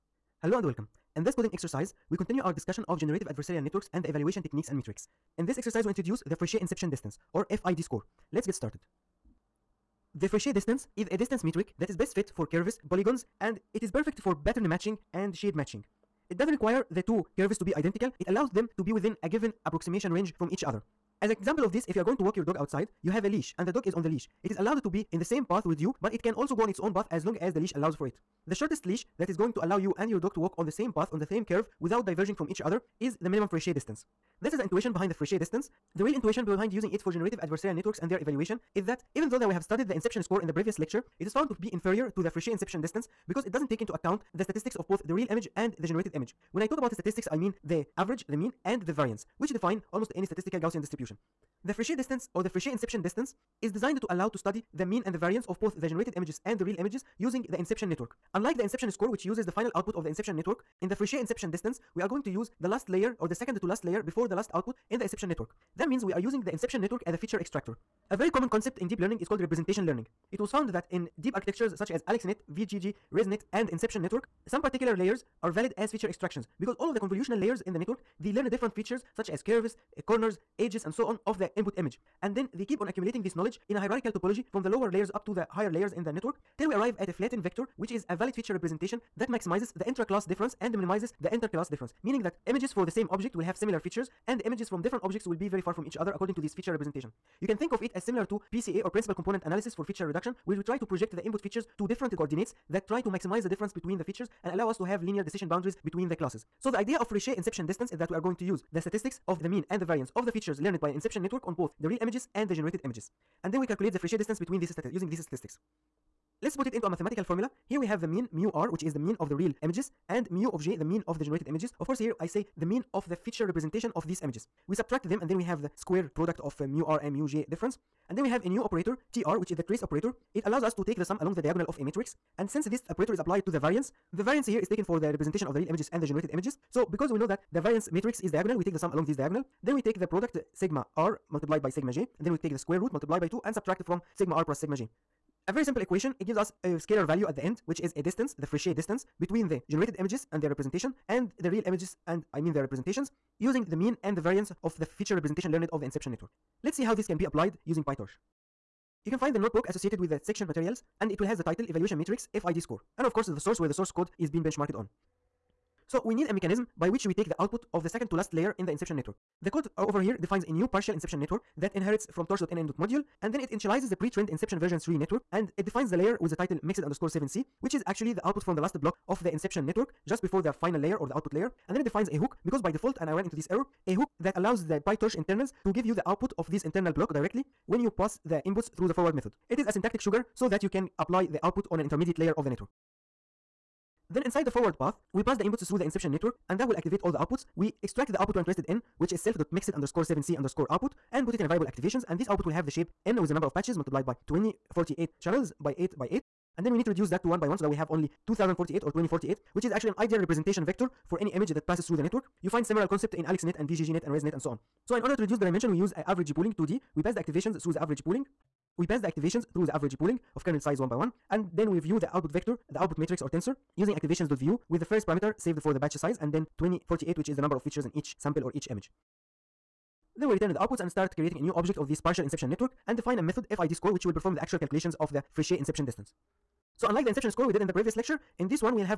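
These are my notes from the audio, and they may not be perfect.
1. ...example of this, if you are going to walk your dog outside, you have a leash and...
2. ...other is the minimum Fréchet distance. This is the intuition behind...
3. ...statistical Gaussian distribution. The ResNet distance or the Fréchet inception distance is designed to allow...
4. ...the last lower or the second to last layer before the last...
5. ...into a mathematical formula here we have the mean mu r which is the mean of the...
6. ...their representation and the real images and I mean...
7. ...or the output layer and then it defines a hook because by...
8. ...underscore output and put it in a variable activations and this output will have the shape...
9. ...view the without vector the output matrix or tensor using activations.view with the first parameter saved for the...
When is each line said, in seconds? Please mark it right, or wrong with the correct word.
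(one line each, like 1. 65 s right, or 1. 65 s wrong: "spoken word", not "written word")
1. 21 s right
2. 32 s right
3. 50 s wrong: "Fréchet", not "ResNet"
4. 62 s wrong: "layer", not "lower"
5. 116 s right
6. 150 s right
7. 180 s right
8. 200 s right
9. 221 s wrong: "output", not "without".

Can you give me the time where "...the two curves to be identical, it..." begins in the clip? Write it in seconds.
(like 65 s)
16 s.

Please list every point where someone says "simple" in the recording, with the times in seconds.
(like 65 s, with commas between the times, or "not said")
145 s.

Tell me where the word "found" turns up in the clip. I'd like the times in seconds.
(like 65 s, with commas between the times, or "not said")
41 s, 70 s.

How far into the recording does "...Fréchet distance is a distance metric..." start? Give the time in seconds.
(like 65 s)
10 s.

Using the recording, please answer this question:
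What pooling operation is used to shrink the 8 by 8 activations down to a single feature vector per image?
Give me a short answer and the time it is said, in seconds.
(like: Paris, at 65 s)
average pooling 2D, at 216 s.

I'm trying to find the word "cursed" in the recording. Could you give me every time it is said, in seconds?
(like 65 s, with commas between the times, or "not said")
not said.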